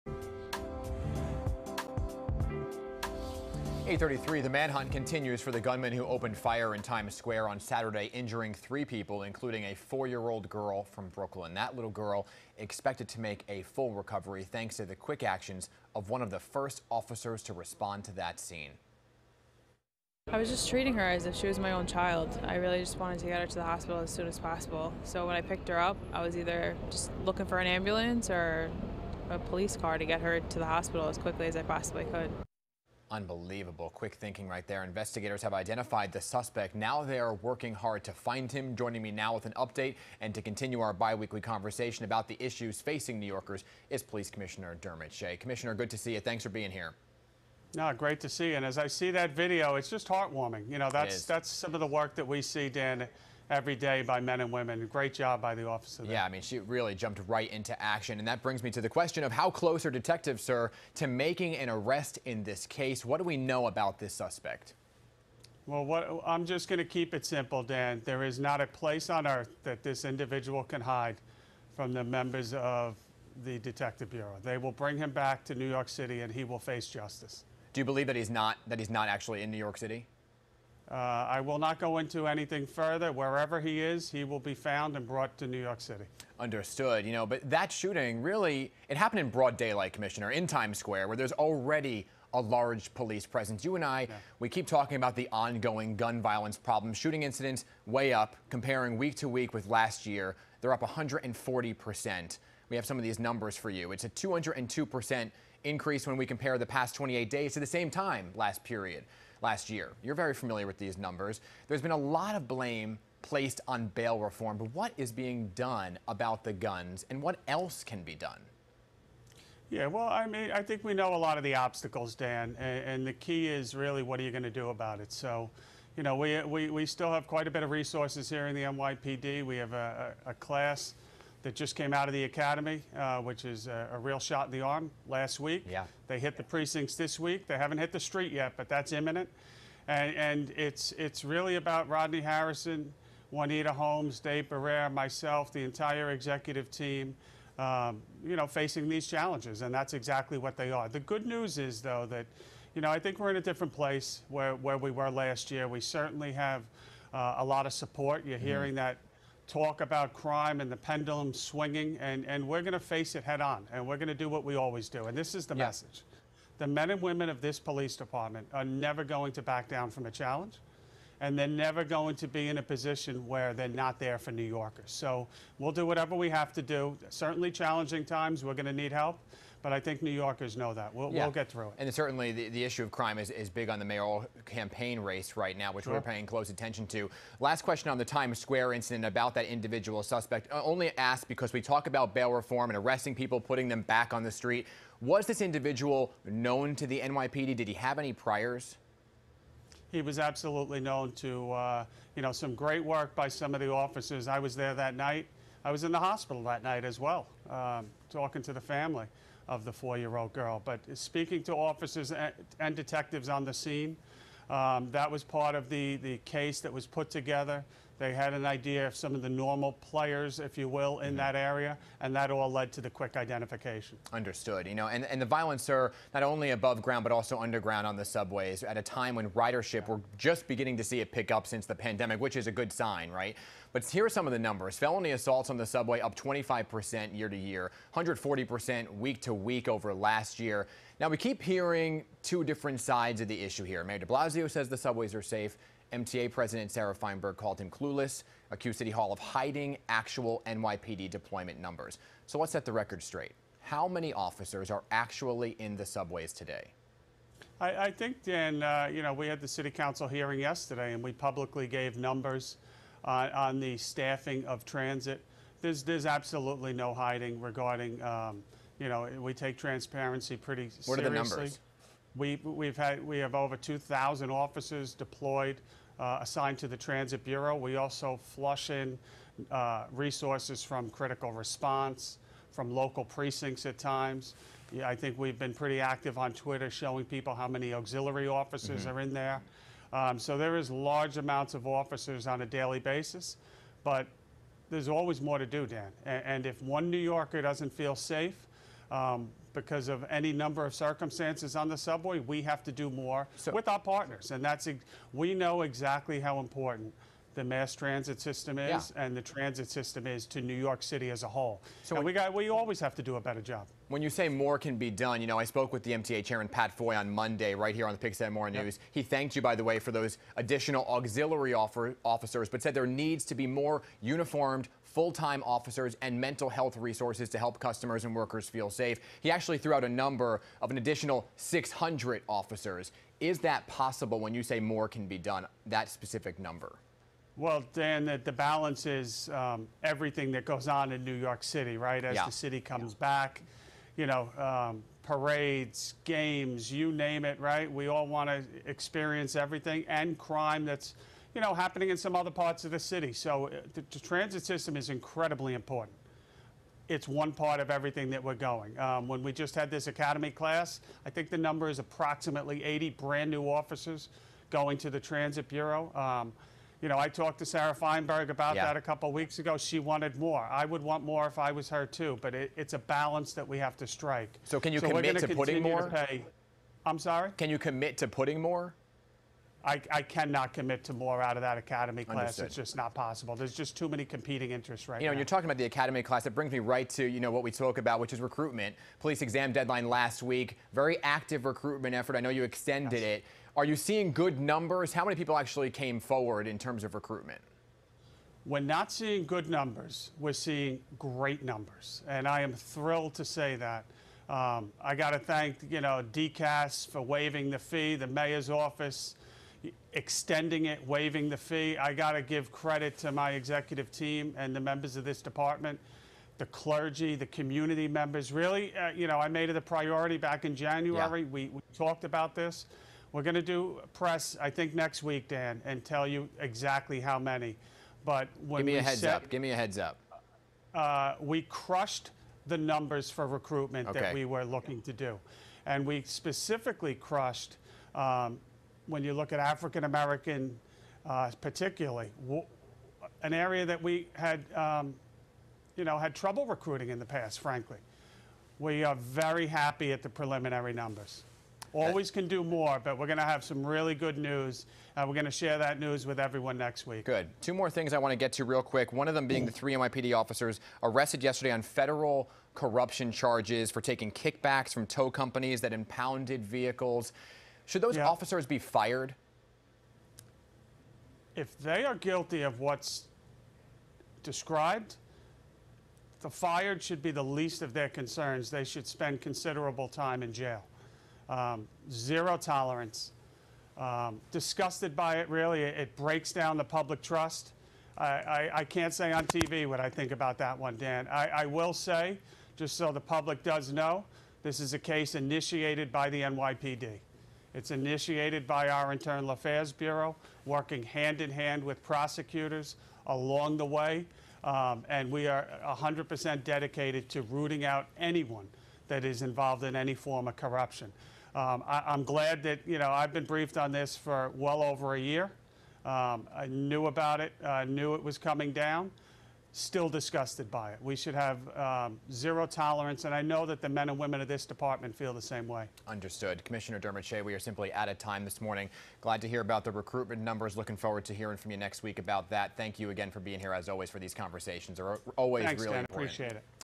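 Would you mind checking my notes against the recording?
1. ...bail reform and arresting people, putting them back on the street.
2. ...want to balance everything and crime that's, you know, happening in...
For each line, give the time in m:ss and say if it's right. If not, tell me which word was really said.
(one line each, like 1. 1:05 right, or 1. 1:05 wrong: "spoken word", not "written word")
1. 3:12 right
2. 5:48 wrong: "experience", not "balance".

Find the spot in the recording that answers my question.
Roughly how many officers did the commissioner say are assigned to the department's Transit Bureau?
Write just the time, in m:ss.
4:33.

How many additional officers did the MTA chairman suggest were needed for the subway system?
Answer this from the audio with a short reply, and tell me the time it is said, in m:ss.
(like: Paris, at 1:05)
600, at 5:31.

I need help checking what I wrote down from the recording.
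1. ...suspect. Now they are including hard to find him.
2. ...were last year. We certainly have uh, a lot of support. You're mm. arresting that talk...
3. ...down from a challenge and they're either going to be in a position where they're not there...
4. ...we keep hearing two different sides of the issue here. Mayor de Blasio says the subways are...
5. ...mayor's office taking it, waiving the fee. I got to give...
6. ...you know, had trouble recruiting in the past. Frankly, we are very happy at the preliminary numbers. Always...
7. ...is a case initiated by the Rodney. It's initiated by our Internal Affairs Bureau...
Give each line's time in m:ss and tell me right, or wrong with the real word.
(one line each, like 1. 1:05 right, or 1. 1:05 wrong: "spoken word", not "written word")
1. 0:36 wrong: "working", not "including"
2. 2:34 wrong: "hearing", not "arresting"
3. 2:49 wrong: "never", not "either"
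4. 4:01 right
5. 6:48 wrong: "extending", not "taking"
6. 7:25 right
7. 8:14 wrong: "NYPD", not "Rodney".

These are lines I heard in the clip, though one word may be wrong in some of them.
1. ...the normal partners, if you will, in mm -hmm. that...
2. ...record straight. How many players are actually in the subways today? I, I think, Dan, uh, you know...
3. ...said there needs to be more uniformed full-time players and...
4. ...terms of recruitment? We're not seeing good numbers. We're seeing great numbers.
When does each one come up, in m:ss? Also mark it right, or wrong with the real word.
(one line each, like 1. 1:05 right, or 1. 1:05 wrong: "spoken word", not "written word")
1. 3:39 wrong: "players", not "partners"
2. 4:12 wrong: "officers", not "players"
3. 5:22 wrong: "officers", not "players"
4. 6:36 right.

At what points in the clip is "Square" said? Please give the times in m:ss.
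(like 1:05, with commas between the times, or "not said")
0:07, 1:30, 3:08.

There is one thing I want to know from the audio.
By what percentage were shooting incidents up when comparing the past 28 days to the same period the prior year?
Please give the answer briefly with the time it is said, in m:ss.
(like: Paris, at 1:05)
202%, at 1:44.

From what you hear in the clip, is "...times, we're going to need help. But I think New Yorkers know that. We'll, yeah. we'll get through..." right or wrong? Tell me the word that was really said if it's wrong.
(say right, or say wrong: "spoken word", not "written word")
right.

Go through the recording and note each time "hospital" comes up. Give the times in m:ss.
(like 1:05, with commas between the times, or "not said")
0:23, 0:30, 3:25.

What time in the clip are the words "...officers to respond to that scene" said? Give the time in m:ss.
0:16.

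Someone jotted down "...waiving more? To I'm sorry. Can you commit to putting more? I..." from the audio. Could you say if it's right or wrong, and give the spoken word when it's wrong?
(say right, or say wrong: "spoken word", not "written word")
wrong: "putting", not "waiving".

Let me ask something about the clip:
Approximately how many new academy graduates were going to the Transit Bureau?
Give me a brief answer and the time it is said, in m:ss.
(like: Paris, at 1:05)
80, at 6:02.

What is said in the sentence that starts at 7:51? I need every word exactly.
If they are guilty of what's described, the fired should be the least of their concerns.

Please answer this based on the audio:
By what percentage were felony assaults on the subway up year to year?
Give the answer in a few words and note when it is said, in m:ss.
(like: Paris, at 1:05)
25%, at 3:56.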